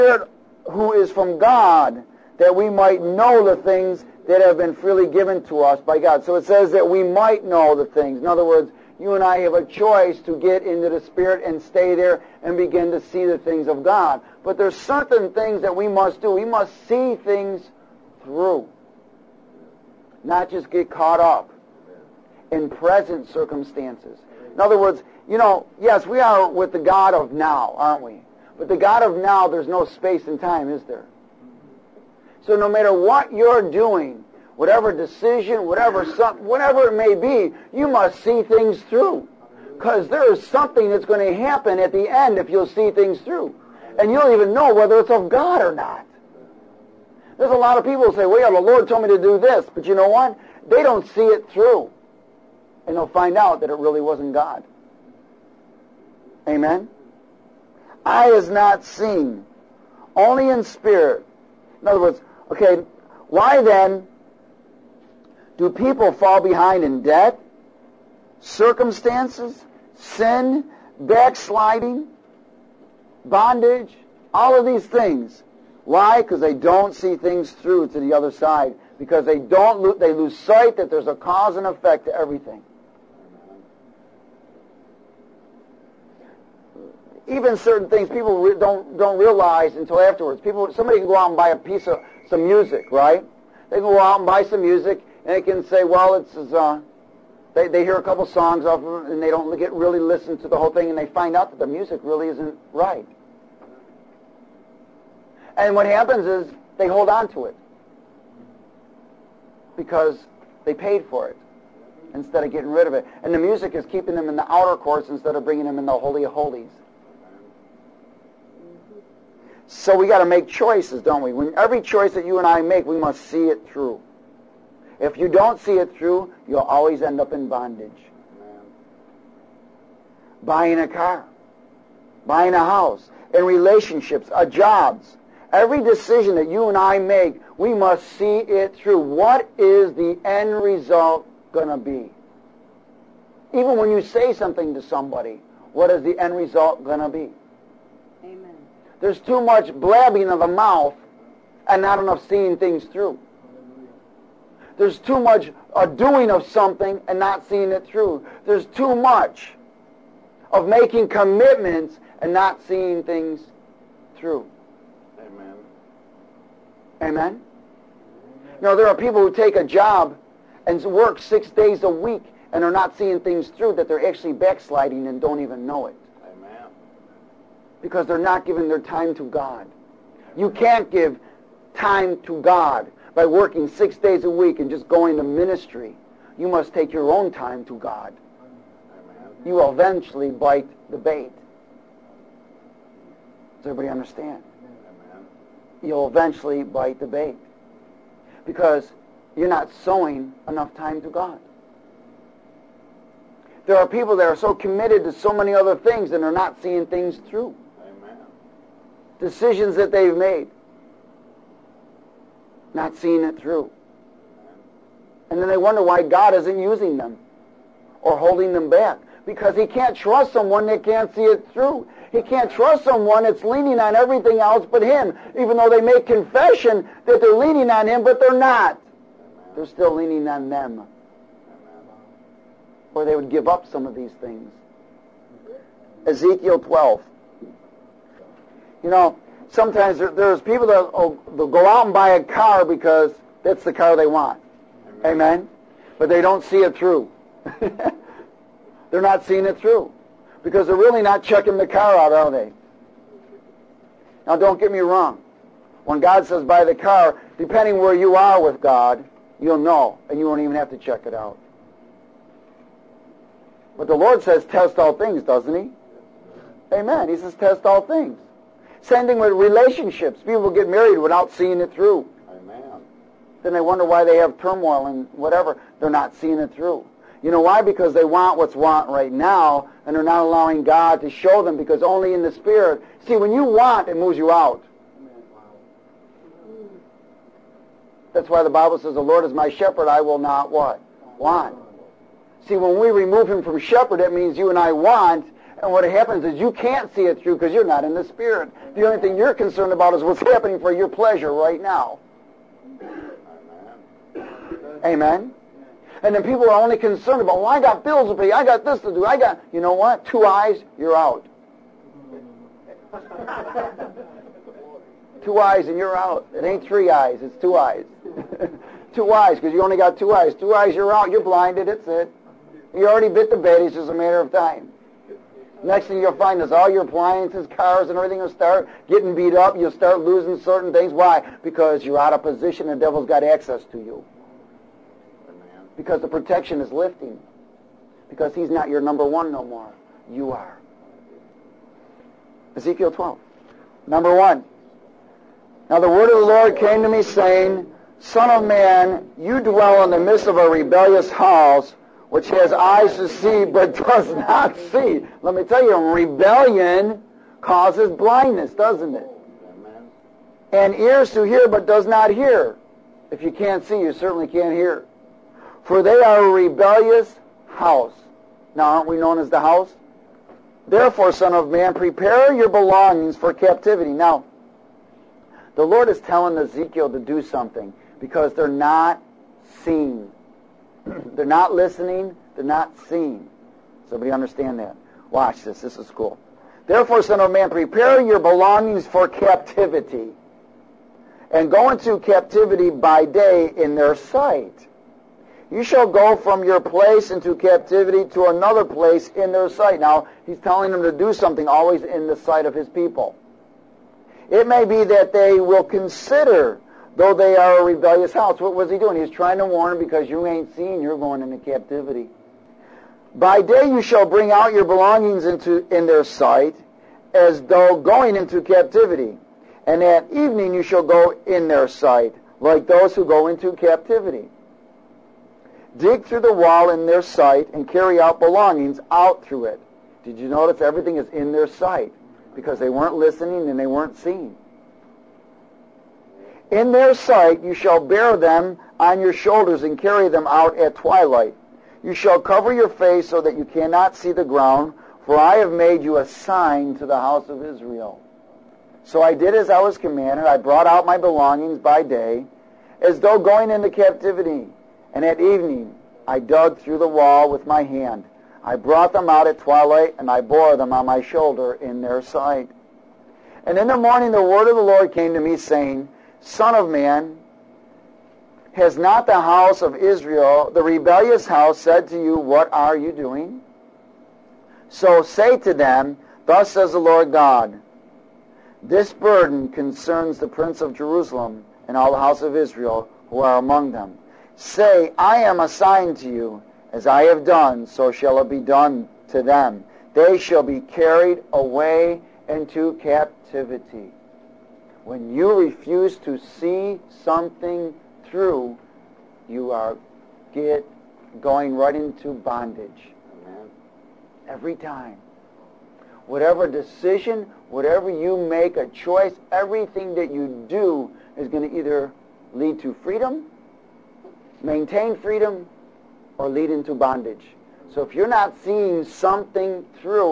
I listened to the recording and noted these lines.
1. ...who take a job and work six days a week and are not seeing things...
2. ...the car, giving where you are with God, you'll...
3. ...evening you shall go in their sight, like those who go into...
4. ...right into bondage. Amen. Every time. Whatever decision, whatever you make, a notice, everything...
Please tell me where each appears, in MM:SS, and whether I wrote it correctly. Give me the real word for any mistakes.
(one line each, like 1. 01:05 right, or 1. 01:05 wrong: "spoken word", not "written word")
1. 02:49 right
2. 04:16 wrong: "depending", not "giving"
3. 07:00 right
4. 08:21 wrong: "choice", not "notice".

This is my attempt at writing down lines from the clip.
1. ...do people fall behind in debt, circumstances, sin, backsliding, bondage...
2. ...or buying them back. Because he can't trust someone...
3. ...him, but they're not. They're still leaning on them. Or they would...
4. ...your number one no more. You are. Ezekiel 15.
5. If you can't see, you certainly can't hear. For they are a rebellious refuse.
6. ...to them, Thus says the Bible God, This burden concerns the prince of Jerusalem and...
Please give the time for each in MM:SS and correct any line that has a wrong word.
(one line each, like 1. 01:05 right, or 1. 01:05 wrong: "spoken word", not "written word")
1. 01:05 right
2. 03:38 wrong: "holding", not "buying"
3. 03:47 right
4. 05:38 wrong: "12", not "15"
5. 06:03 wrong: "house", not "refuse"
6. 07:55 wrong: "Lord", not "Bible".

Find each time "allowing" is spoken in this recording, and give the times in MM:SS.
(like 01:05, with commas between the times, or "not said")
04:40.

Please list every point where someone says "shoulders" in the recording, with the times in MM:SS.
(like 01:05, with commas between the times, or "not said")
07:19, 07:41.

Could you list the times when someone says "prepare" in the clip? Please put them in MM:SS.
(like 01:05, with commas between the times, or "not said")
06:11, 06:27.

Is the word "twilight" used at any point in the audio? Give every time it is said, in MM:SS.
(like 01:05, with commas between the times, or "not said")
07:20, 07:39.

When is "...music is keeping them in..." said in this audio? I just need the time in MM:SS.
01:53.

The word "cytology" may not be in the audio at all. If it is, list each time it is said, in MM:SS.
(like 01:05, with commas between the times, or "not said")
not said.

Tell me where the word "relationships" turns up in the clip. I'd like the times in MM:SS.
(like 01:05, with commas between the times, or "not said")
02:13, 04:29.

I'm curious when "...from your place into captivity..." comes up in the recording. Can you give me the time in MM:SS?
06:36.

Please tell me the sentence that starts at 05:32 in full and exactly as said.
The devil's got access to you.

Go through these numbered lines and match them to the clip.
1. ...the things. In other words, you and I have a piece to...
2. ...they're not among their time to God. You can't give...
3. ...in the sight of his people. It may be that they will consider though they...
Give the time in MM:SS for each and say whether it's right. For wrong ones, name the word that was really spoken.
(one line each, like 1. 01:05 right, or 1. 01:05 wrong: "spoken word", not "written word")
1. 00:07 wrong: "choice", not "piece"
2. 02:58 wrong: "giving", not "among"
3. 06:41 right.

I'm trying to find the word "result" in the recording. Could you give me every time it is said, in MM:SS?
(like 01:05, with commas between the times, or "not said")
02:20, 02:26.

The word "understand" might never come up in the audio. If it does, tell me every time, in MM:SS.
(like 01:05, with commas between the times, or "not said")
03:13, 06:24.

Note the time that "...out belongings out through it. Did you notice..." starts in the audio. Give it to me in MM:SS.
07:07.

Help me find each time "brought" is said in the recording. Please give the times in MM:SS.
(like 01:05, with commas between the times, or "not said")
07:30, 07:38.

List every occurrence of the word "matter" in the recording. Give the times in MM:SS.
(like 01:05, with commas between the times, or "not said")
00:32, 05:23.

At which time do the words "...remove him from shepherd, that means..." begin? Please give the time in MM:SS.
04:52.